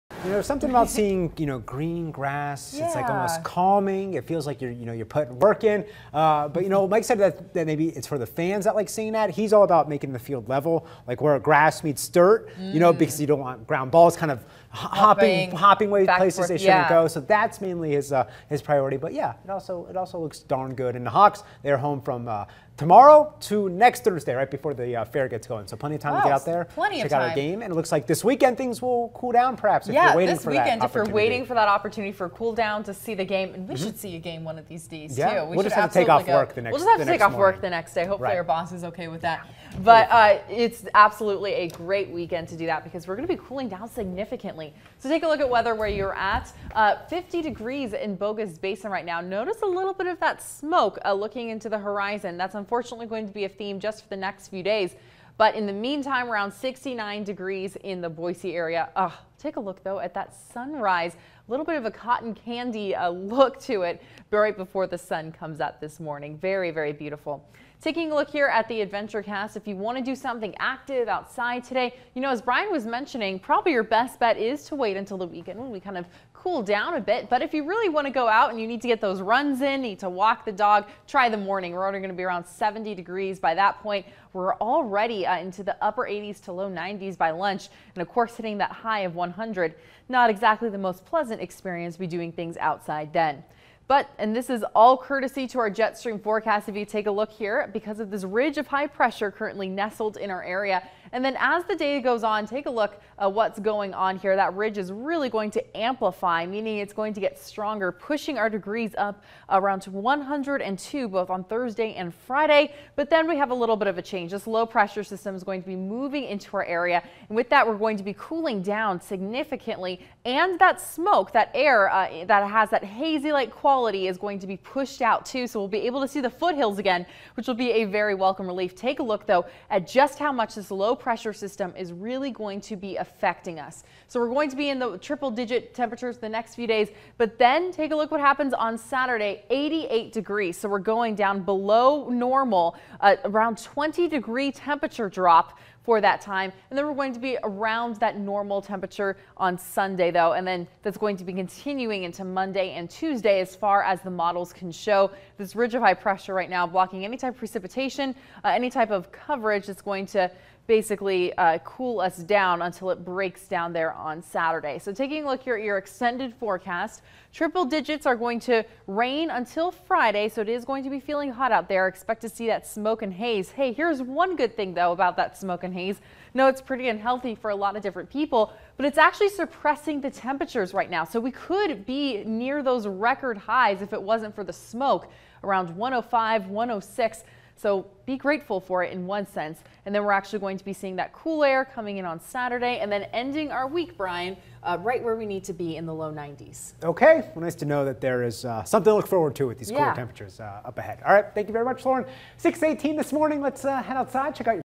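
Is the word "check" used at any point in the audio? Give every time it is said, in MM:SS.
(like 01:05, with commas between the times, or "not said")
00:26, 03:24.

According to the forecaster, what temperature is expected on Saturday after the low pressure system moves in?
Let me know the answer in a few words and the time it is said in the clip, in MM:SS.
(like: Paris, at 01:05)
88 degrees, at 02:19.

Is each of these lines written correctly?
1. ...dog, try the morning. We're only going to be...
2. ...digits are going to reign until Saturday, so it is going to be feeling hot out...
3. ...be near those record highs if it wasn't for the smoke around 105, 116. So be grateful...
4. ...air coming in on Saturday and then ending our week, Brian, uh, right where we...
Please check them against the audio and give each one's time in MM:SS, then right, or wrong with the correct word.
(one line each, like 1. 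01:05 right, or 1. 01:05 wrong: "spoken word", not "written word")
1. 01:20 right
2. 02:47 wrong: "Friday", not "Saturday"
3. 03:01 wrong: "106", not "116"
4. 03:11 right.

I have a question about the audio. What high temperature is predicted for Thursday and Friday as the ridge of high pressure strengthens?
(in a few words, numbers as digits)
102.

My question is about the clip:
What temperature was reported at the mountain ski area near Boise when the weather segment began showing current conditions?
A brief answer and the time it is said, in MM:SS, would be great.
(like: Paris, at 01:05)
50 degrees, at 00:47.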